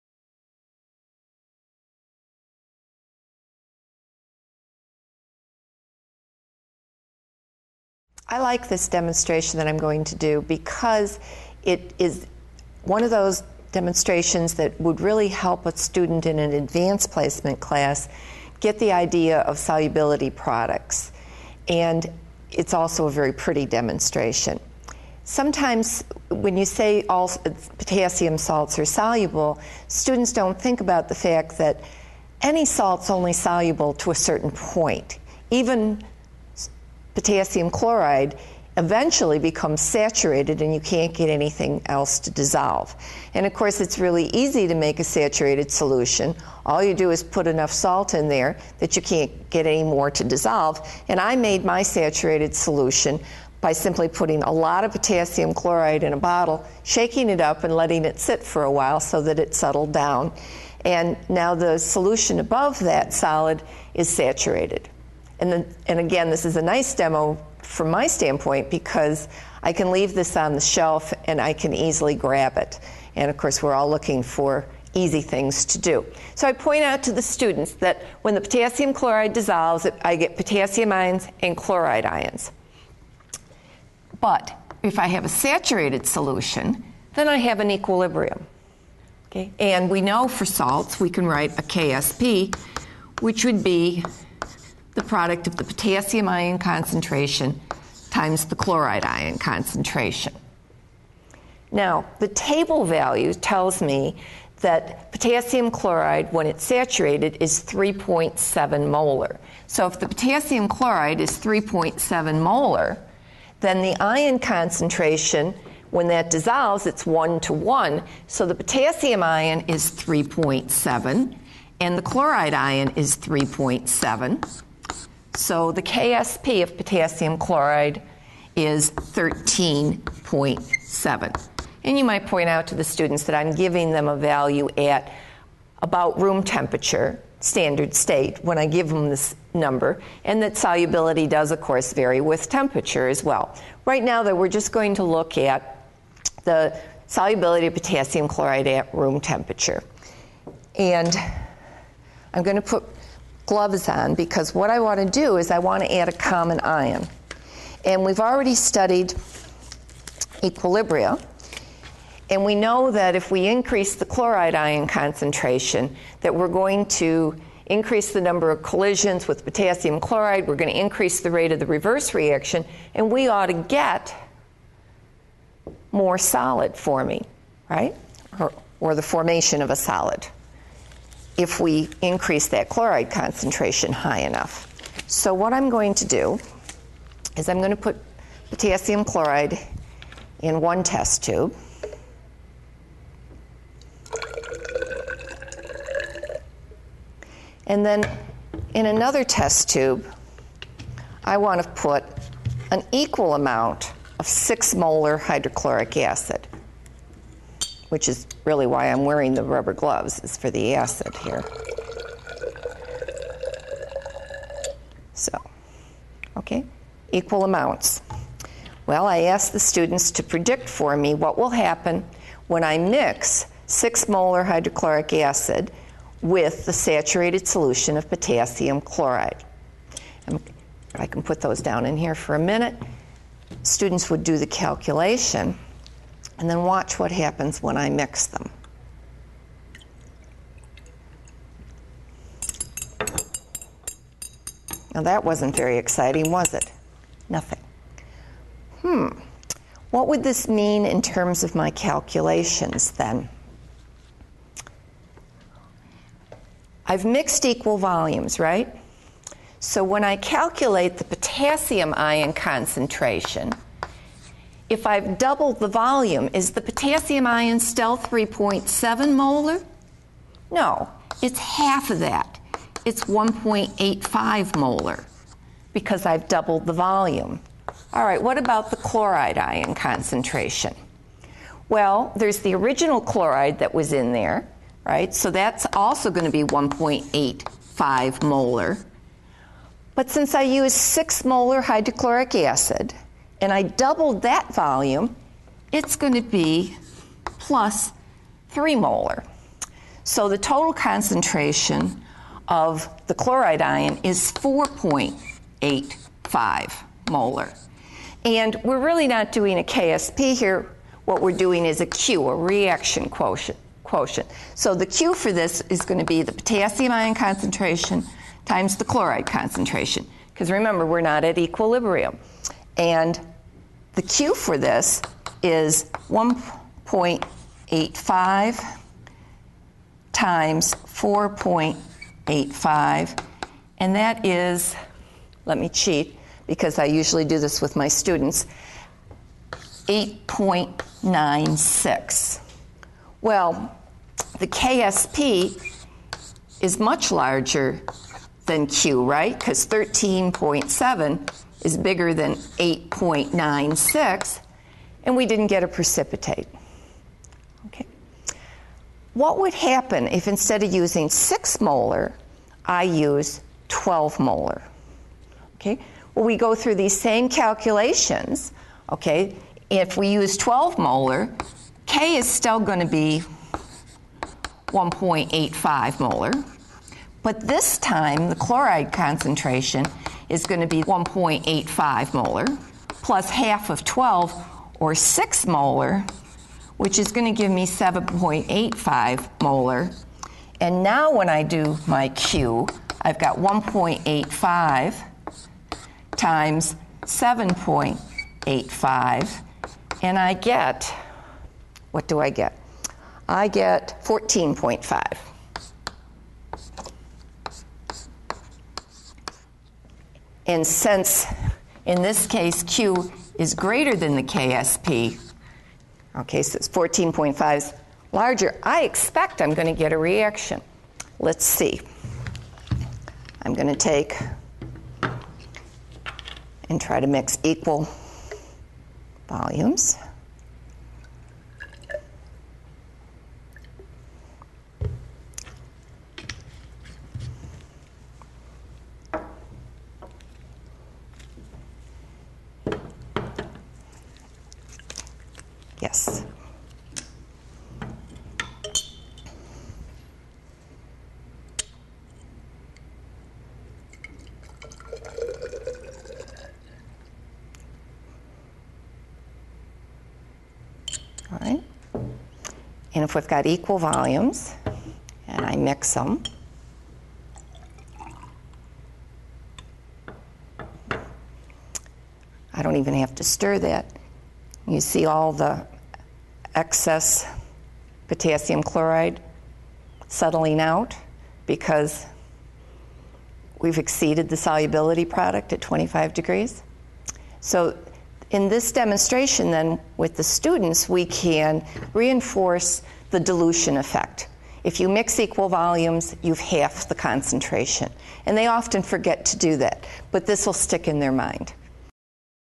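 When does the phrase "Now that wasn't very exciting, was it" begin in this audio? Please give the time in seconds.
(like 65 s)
244 s.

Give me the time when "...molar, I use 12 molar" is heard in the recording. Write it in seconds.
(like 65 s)
361 s.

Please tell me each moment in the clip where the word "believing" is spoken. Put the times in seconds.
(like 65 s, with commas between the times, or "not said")
not said.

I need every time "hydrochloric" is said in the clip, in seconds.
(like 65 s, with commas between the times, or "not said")
205 s, 224 s, 291 s.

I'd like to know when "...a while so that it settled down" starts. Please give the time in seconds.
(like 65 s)
58 s.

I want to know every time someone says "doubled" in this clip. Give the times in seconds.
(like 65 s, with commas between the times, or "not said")
265 s, 276 s, 293 s.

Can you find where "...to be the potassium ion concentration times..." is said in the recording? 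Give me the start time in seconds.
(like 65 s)
315 s.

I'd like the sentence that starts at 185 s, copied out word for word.
So what I'm going to do is I'm going to put potassium chloride in one test tube.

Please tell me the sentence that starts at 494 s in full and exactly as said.
If you mix equal volumes, you've half the concentration.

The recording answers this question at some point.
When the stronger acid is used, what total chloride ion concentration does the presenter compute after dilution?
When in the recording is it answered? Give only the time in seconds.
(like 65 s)
387 s.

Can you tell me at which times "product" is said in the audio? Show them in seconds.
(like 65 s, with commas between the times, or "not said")
20 s, 95 s, 485 s.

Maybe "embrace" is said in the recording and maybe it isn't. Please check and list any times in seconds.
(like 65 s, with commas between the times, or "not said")
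not said.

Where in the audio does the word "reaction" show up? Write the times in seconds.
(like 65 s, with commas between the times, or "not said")
172 s, 312 s, 419 s.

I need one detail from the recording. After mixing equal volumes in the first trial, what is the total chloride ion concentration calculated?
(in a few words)
4.85 molar.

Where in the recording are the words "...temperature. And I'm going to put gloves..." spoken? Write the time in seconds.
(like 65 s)
149 s.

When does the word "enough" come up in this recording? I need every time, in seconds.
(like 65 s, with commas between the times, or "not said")
47 s, 184 s.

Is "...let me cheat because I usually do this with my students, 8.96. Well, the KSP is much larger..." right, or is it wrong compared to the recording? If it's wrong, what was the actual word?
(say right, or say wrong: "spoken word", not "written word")
right.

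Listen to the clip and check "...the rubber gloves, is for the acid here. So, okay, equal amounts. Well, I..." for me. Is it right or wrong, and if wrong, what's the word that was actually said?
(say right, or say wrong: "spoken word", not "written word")
right.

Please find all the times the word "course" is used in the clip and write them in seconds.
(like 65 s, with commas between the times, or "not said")
43 s, 73 s, 141 s.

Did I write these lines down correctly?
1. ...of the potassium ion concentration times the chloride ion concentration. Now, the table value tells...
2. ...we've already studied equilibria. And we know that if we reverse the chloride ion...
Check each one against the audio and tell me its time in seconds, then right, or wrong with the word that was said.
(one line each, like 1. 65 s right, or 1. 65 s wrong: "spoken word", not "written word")
1. 95 s right
2. 158 s wrong: "increase", not "reverse".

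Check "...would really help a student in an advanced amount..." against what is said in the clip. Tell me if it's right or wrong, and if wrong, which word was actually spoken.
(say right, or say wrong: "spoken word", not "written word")
wrong: "placement", not "amount".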